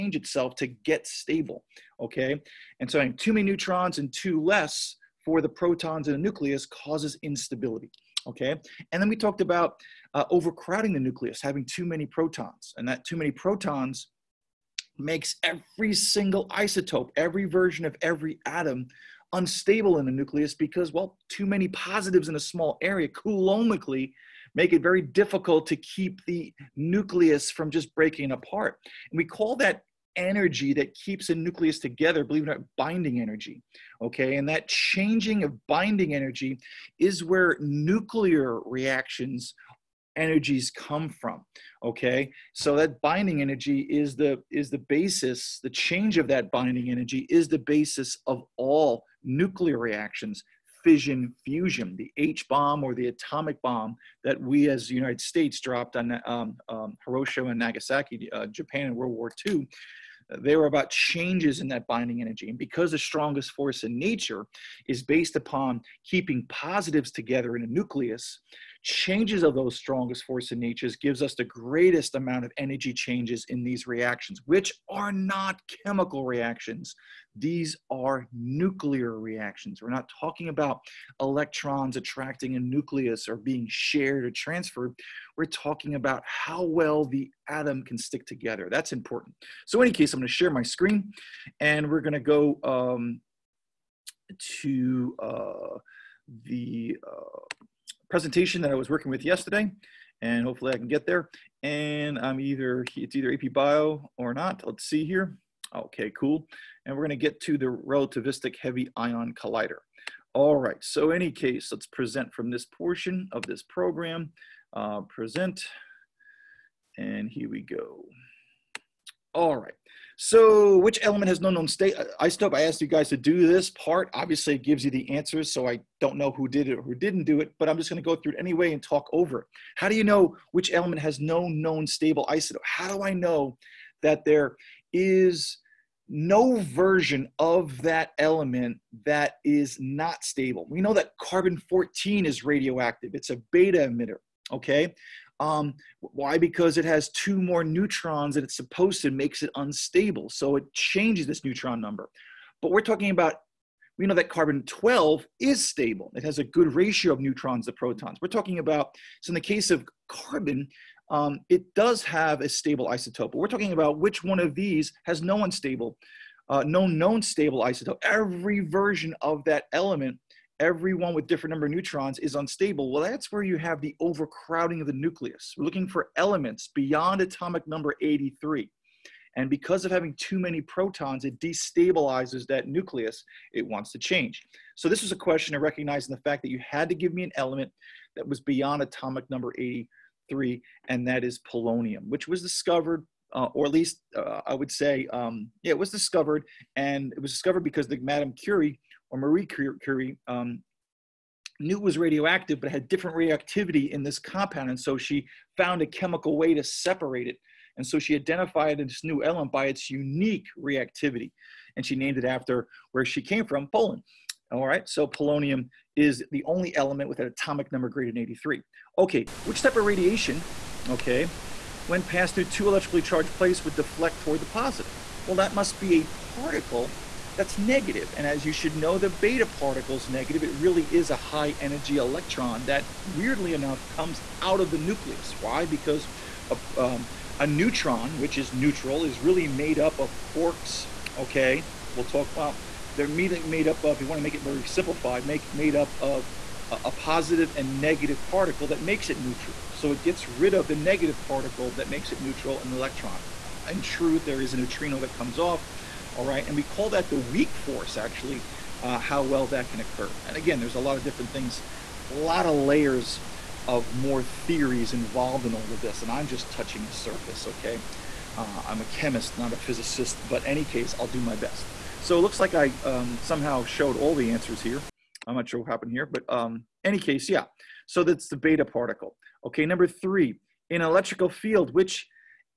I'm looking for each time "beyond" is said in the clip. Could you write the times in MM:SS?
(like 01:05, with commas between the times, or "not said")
02:56, 03:08.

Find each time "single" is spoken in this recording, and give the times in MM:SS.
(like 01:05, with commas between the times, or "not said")
00:15.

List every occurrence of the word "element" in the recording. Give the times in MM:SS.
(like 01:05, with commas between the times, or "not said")
02:01, 02:10, 02:18, 02:49, 02:56, 03:07, 03:29, 03:36.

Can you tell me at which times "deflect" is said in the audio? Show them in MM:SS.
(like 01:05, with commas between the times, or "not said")
03:43.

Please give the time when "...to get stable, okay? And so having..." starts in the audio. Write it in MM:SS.
00:00.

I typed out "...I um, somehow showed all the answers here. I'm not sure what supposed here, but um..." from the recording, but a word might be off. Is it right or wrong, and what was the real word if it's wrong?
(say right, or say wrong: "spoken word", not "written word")
wrong: "happened", not "supposed".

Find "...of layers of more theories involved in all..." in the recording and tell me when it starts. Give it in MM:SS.
04:22.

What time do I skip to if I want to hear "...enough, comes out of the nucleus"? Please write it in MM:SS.
03:53.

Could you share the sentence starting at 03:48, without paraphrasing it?
And as you should know, the beta particle is negative.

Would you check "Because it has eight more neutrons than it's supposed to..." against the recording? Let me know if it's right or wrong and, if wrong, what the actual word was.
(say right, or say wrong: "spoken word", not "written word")
wrong: "two", not "eight".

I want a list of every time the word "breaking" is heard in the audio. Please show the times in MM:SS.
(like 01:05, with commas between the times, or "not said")
00:27.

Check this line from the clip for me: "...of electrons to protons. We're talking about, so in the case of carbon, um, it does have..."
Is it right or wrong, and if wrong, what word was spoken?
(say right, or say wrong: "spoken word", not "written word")
wrong: "neutrons", not "electrons".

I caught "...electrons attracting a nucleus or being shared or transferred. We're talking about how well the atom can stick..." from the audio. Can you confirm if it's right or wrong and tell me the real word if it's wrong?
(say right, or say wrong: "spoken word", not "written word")
right.